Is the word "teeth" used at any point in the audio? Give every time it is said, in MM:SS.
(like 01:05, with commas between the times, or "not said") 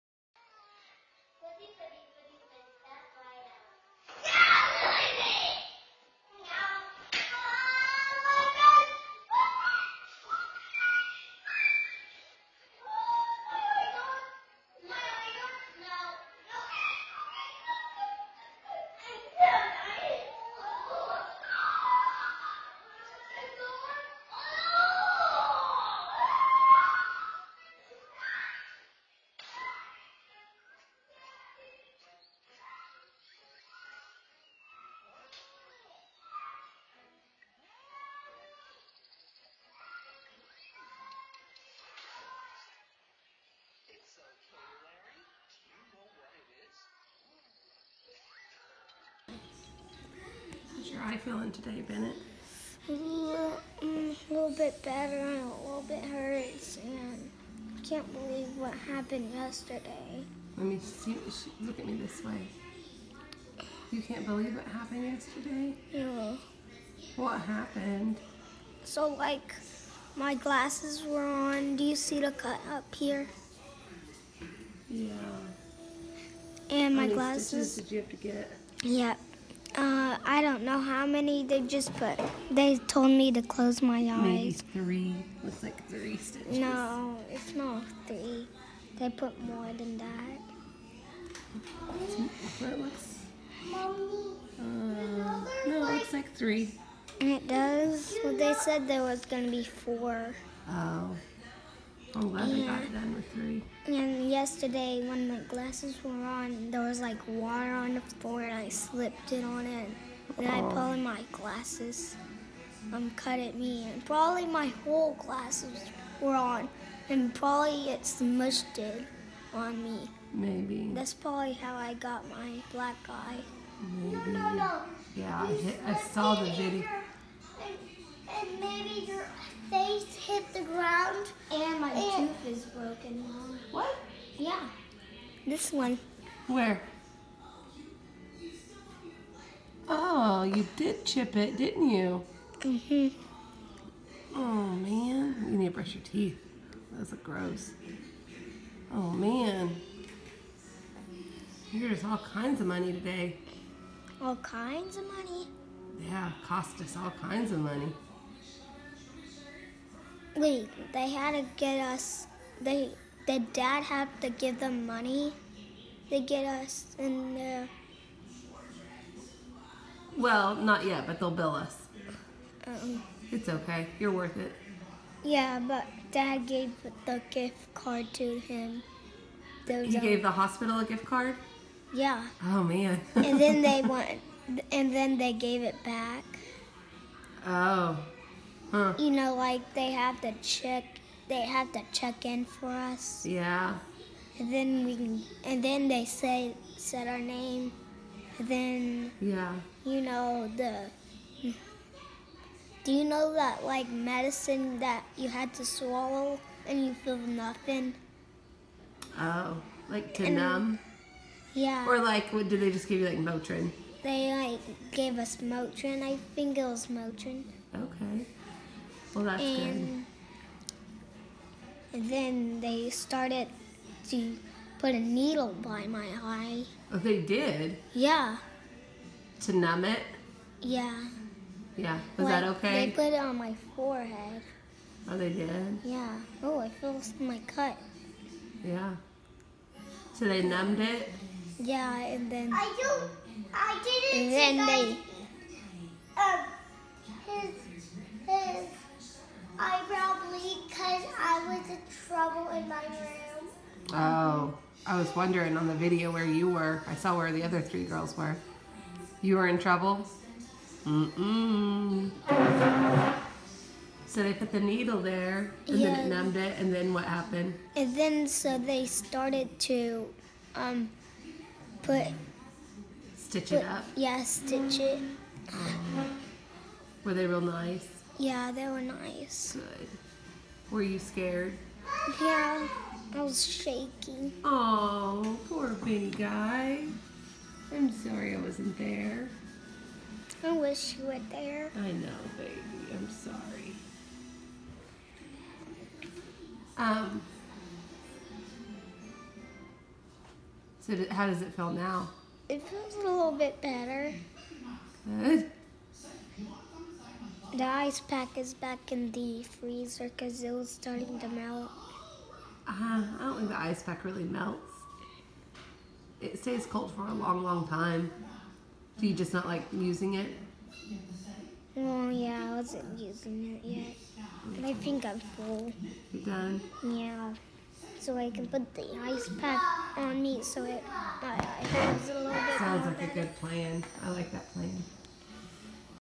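02:26.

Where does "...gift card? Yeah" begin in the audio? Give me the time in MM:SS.
03:00.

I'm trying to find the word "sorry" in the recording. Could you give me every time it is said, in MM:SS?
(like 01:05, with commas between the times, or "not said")
04:47, 04:53.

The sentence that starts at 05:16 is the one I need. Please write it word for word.
It stays cold for a long, long time.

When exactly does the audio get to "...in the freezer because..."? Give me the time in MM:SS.
05:08.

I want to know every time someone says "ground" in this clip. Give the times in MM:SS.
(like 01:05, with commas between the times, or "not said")
02:10.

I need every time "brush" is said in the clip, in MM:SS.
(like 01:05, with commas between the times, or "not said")
02:25.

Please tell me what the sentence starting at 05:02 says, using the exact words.
It feels a little bit better.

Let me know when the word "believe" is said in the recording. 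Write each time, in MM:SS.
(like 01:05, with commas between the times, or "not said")
00:58, 01:04.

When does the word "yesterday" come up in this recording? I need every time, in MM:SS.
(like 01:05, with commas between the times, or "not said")
00:59, 01:05, 01:44.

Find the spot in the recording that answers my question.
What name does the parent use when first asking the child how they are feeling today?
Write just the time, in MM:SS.
00:51.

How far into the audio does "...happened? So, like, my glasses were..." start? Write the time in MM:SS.
01:07.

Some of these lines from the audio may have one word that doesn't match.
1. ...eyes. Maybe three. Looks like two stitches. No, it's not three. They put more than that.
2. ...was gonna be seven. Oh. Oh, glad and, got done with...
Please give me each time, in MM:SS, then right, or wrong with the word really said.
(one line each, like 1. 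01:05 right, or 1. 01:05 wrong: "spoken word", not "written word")
1. 01:23 wrong: "three", not "two"
2. 01:39 wrong: "four", not "seven".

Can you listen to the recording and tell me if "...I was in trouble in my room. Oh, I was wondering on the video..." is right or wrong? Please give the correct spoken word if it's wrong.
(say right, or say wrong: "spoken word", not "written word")
right.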